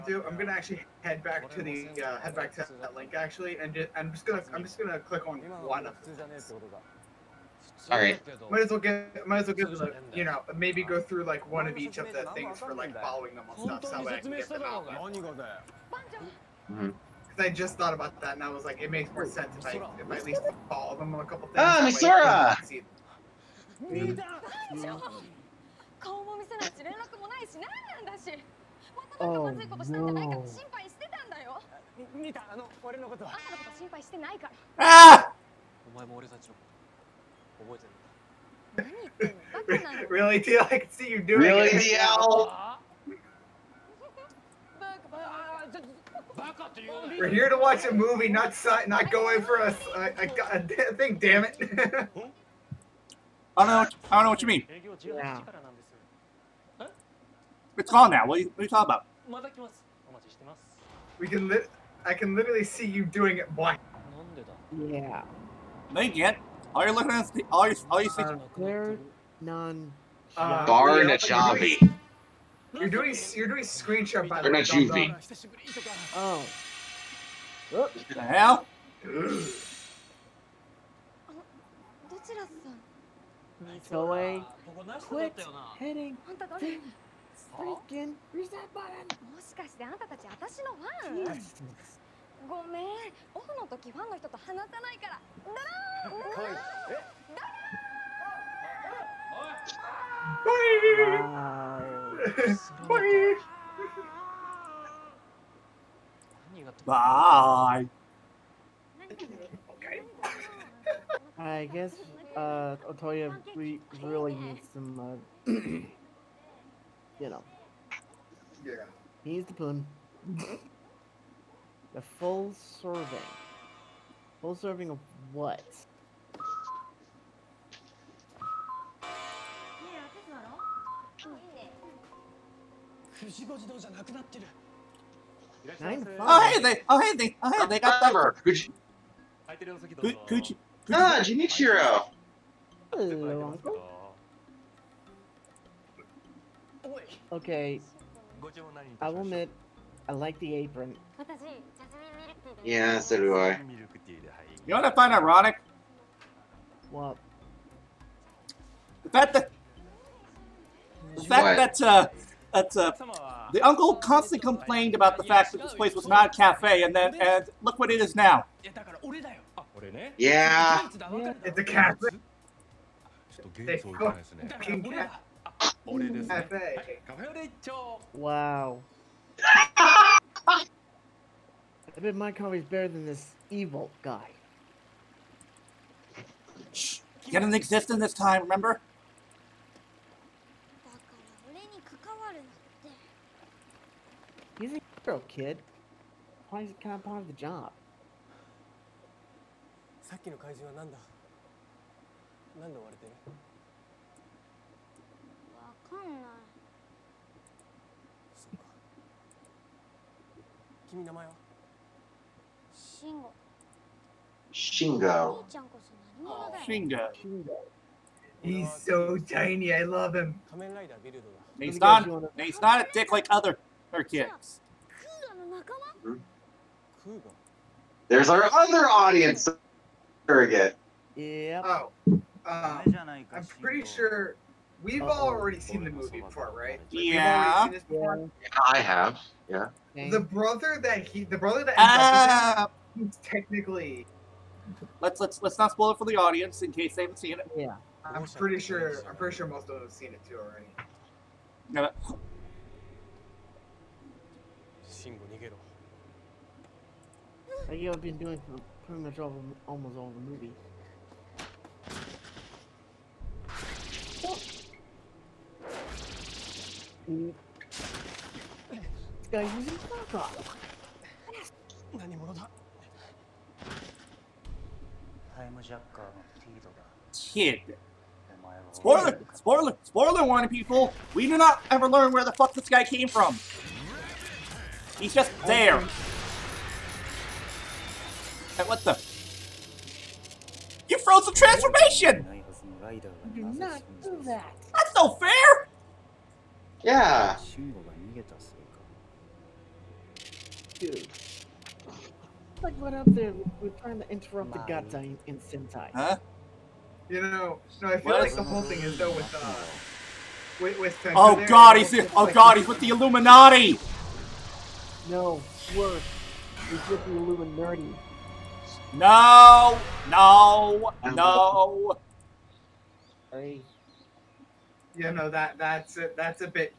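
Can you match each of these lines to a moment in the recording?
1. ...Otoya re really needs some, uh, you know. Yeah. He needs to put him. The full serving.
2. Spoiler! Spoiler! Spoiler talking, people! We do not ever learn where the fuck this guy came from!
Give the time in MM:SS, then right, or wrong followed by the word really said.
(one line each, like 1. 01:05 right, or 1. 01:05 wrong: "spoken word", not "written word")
1. 01:52 right
2. 04:38 wrong: "warning", not "talking".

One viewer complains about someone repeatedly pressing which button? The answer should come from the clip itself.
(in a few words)
reset button.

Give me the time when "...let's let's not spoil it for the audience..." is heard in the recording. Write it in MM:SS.
04:05.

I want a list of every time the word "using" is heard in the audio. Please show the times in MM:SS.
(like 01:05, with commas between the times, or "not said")
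04:29.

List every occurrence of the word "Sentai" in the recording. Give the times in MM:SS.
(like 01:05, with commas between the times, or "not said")
05:05, 05:11.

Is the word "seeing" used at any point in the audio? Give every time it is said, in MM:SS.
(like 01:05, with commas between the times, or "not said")
01:08.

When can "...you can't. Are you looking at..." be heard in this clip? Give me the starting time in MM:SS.
01:06.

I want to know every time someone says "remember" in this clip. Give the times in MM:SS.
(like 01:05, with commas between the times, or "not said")
02:18, 03:08.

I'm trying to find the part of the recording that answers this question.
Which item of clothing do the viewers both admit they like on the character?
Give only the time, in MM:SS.
02:30.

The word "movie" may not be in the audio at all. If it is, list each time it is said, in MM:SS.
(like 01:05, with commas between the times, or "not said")
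00:47, 03:55, 04:20.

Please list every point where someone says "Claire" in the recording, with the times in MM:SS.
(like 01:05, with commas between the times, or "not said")
01:08.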